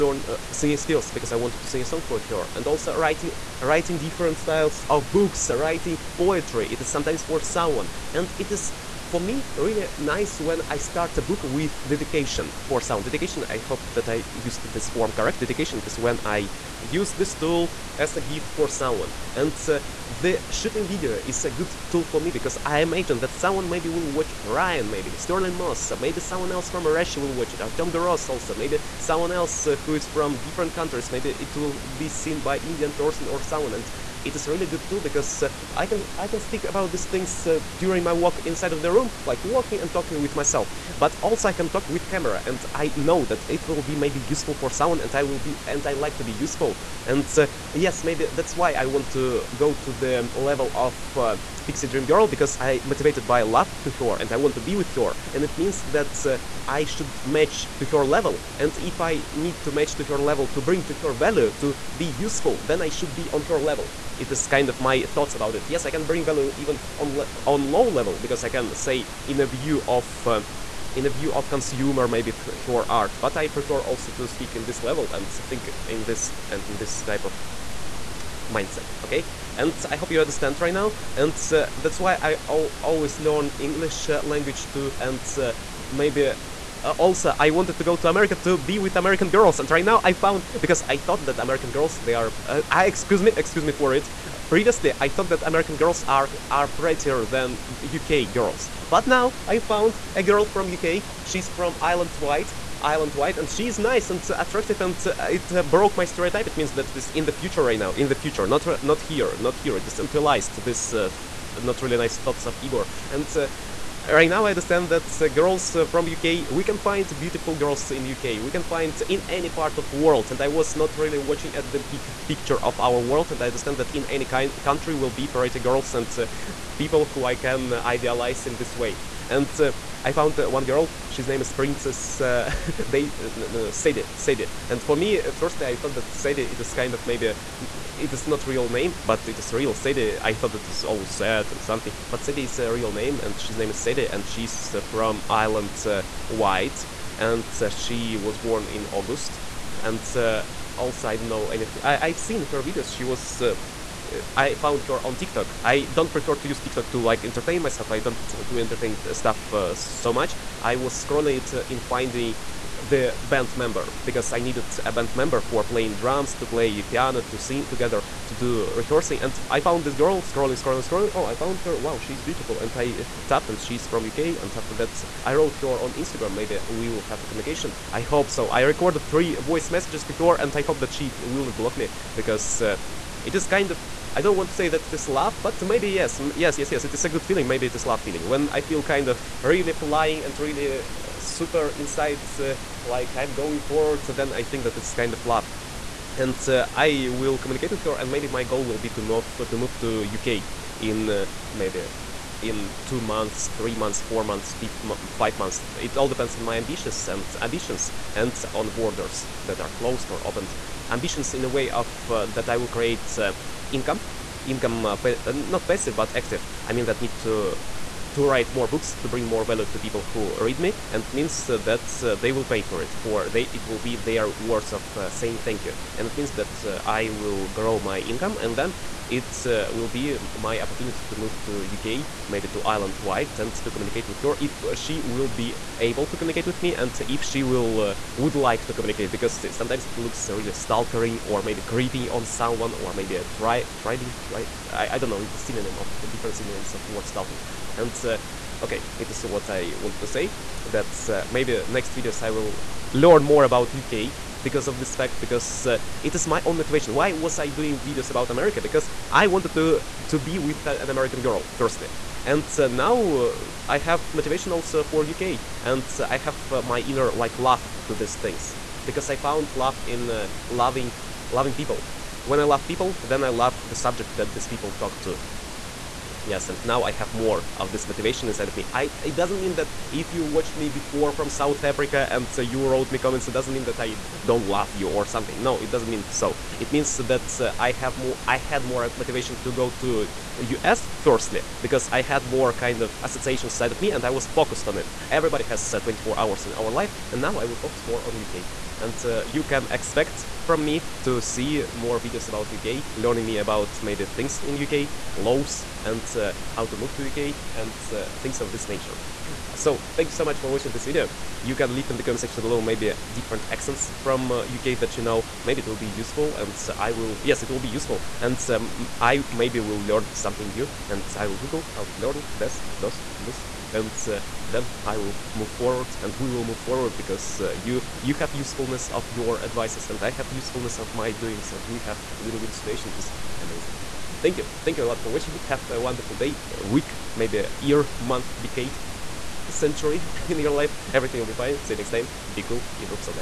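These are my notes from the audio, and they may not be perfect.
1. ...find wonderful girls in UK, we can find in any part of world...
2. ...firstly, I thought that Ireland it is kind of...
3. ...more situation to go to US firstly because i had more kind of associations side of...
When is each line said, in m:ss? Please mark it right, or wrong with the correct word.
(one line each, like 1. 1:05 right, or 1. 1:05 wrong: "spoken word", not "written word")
1. 1:56 wrong: "beautiful", not "wonderful"
2. 2:15 wrong: "Sadie", not "Ireland"
3. 4:48 wrong: "motivation", not "situation".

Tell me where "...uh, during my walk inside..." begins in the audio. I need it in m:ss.
0:37.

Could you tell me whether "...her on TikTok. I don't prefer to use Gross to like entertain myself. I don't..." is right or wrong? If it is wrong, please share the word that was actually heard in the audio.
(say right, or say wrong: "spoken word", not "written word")
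wrong: "TikTok", not "Gross".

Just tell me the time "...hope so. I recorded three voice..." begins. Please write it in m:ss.
2:58.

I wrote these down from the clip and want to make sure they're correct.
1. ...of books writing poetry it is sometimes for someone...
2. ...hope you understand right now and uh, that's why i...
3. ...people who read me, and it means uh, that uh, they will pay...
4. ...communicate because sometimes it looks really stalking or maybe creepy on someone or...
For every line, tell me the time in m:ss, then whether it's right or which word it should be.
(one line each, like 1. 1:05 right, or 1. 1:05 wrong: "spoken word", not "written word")
1. 0:04 right
2. 1:19 right
3. 3:39 right
4. 3:58 right.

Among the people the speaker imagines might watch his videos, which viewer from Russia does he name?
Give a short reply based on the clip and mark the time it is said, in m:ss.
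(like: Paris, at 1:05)
Artem Gross, at 0:27.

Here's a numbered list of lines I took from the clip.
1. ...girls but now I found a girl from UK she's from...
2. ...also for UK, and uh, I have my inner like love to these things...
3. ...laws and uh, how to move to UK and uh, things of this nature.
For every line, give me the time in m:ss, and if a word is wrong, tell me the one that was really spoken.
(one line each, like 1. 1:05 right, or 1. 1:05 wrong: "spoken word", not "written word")
1. 1:38 right
2. 4:24 right
3. 5:05 right.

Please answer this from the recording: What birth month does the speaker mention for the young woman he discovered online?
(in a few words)
August.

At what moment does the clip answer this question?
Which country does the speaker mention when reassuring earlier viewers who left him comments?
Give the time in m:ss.
4:41.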